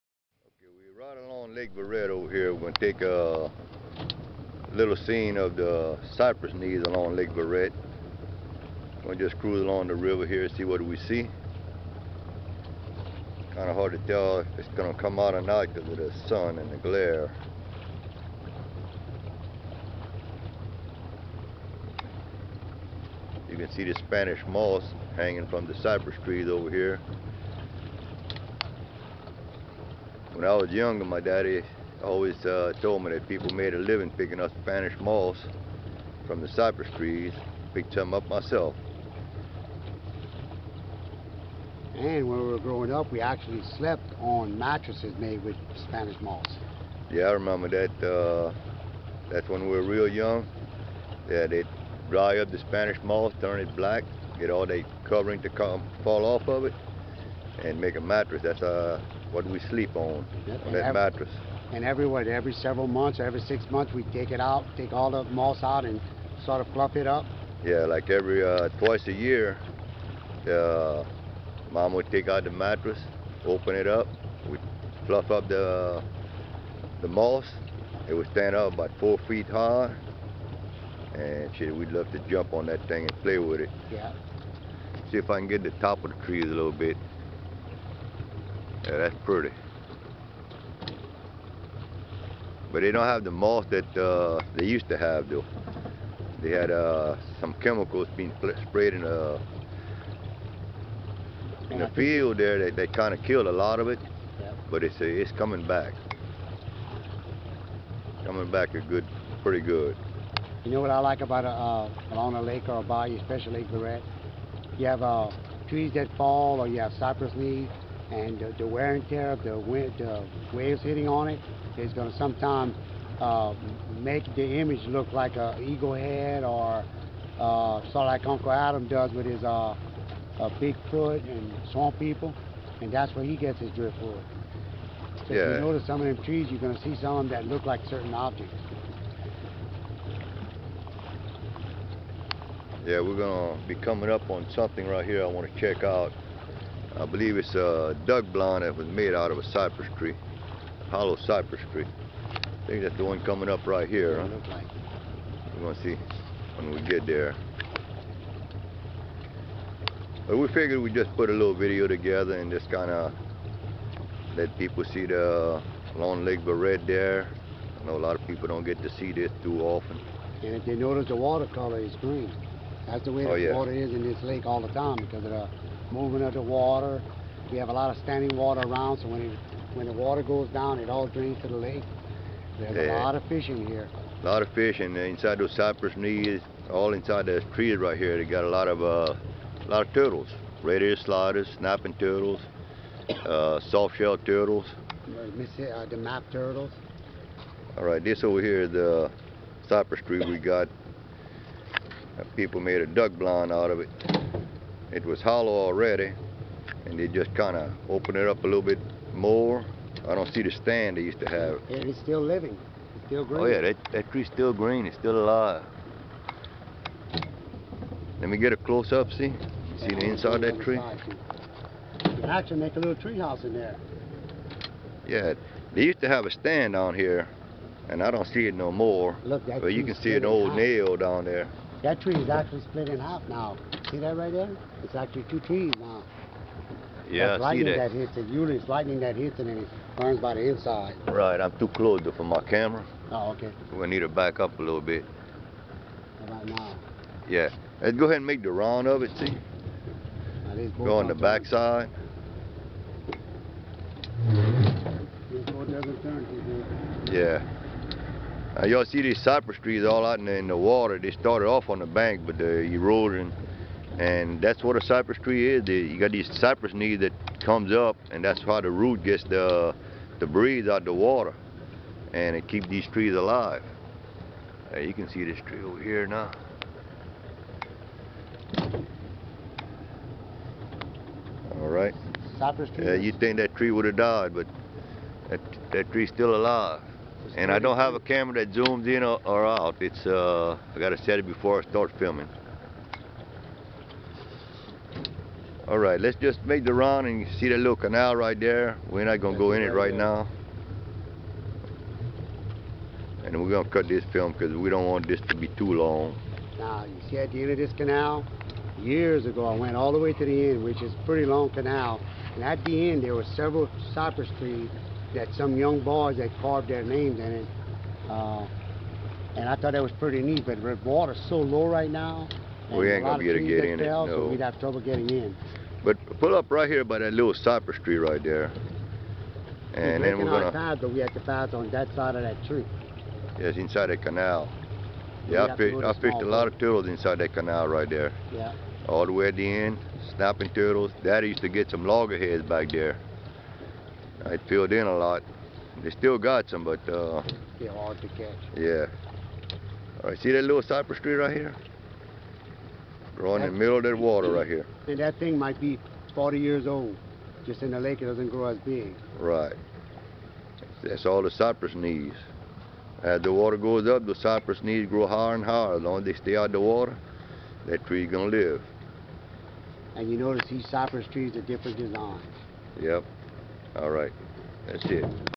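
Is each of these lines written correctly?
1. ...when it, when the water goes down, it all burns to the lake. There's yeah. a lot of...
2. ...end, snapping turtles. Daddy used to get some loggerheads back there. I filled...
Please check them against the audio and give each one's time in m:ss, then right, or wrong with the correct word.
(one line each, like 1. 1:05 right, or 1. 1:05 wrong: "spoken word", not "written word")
1. 2:59 wrong: "drains", not "burns"
2. 5:39 right.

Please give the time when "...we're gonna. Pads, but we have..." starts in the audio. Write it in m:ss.
5:30.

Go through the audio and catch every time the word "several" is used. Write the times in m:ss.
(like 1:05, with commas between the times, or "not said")
1:02, 5:13.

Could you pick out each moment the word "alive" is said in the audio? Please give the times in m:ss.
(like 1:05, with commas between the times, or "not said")
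3:35, 4:33, 4:46.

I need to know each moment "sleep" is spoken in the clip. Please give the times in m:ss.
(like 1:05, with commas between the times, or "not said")
0:59.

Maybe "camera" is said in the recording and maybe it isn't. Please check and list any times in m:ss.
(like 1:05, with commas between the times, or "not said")
4:02, 4:47.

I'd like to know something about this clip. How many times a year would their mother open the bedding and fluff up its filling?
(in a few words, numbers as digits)
Twice.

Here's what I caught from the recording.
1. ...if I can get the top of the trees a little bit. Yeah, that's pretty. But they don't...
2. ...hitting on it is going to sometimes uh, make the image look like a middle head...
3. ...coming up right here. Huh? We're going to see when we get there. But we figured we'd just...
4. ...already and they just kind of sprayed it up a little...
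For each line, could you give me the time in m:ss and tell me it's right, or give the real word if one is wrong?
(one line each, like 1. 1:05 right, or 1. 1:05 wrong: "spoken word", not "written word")
1. 1:25 right
2. 2:00 wrong: "eagle", not "middle"
3. 2:33 right
4. 3:25 wrong: "opened", not "sprayed".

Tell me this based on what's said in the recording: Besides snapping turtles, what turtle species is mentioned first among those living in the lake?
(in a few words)
Red-eared sliders.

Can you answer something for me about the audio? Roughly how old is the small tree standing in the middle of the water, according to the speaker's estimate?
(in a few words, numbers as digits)
40 years.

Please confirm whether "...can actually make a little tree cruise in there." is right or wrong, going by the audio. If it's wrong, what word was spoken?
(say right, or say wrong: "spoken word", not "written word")
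wrong: "house", not "cruise".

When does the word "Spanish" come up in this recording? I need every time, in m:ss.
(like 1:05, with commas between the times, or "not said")
0:23, 0:34, 0:45, 0:52.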